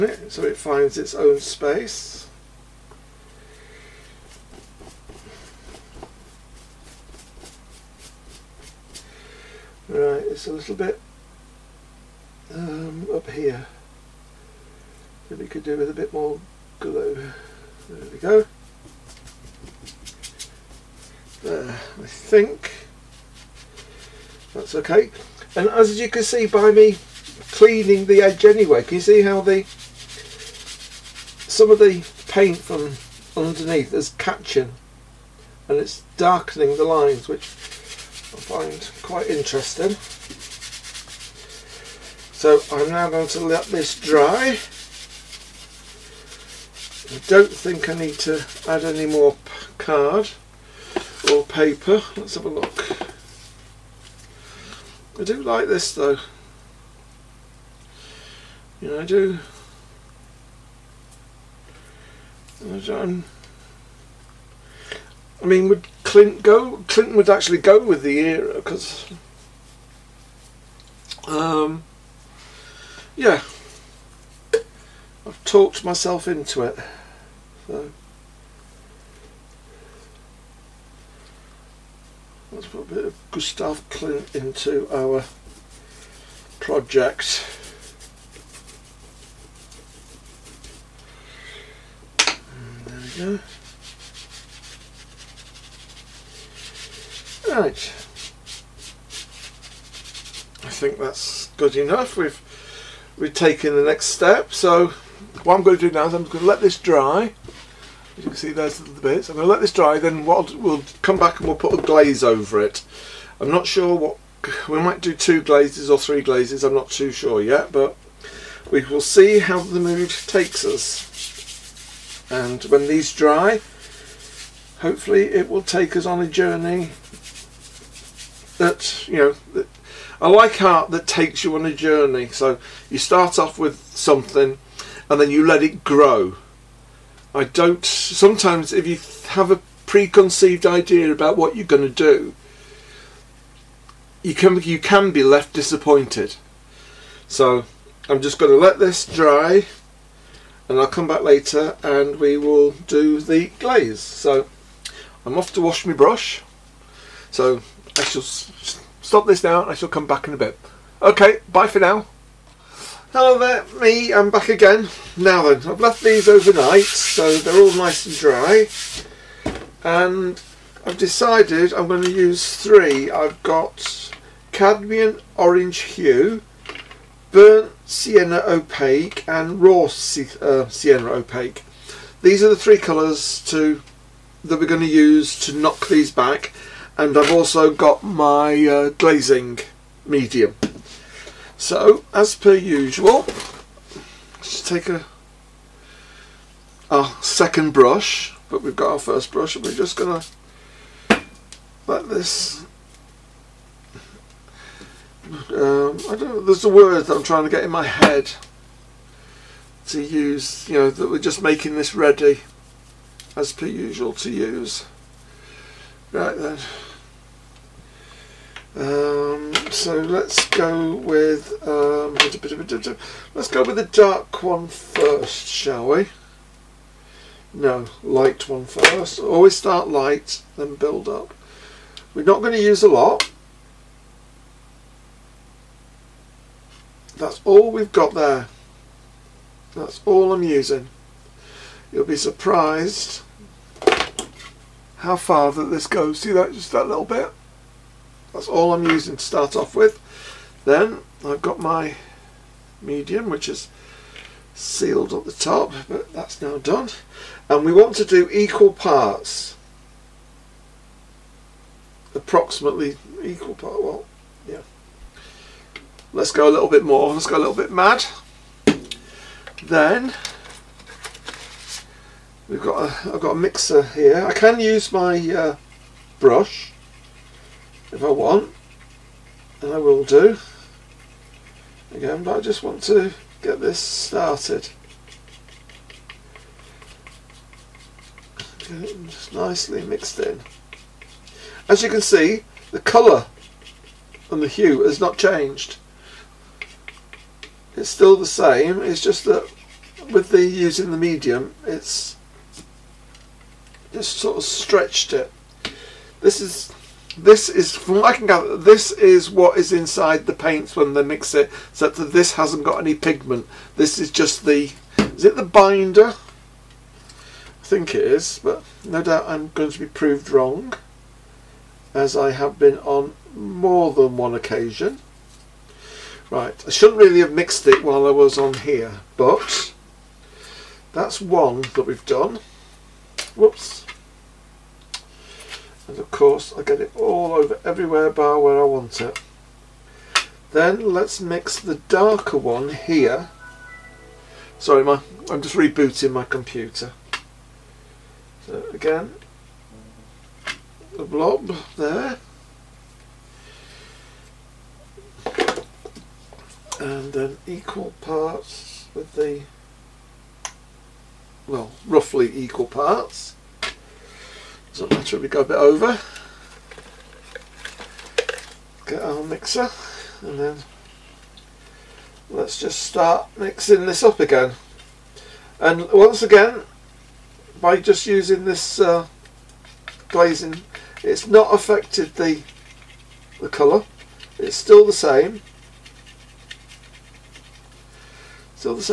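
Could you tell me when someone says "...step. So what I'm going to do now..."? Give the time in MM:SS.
01:44.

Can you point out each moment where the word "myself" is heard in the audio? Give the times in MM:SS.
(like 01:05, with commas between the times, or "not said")
01:15.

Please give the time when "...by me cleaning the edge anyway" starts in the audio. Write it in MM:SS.
00:26.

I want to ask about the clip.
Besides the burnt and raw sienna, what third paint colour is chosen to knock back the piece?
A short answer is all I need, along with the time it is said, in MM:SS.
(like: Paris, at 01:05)
cadmium orange hue, at 02:54.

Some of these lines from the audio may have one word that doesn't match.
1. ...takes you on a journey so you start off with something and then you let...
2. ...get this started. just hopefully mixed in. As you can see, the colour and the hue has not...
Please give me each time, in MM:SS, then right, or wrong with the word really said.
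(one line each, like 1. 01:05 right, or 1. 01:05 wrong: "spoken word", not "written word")
1. 02:11 right
2. 04:43 wrong: "nicely", not "hopefully".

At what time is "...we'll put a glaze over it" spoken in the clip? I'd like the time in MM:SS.
01:51.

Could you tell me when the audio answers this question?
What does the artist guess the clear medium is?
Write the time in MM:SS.
05:15.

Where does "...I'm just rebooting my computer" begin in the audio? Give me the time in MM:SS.
05:45.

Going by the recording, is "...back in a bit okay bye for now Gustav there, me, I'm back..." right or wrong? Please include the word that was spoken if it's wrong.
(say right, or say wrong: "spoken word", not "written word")
wrong: "Hello", not "Gustav".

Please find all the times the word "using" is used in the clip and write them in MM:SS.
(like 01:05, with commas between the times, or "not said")
04:00, 04:08, 05:00, 06:18.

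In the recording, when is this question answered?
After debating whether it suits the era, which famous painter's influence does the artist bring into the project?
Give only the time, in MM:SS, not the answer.
01:23.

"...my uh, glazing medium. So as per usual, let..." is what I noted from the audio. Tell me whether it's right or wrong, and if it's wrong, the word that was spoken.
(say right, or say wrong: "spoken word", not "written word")
right.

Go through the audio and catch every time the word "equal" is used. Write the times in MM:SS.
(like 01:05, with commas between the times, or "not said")
04:18, 04:23, 05:57, 06:02.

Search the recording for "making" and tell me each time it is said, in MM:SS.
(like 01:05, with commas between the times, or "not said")
03:31.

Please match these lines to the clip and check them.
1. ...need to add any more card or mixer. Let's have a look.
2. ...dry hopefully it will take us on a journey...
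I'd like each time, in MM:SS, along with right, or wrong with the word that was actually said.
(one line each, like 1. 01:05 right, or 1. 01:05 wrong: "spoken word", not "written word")
1. 00:47 wrong: "paper", not "mixer"
2. 02:03 right.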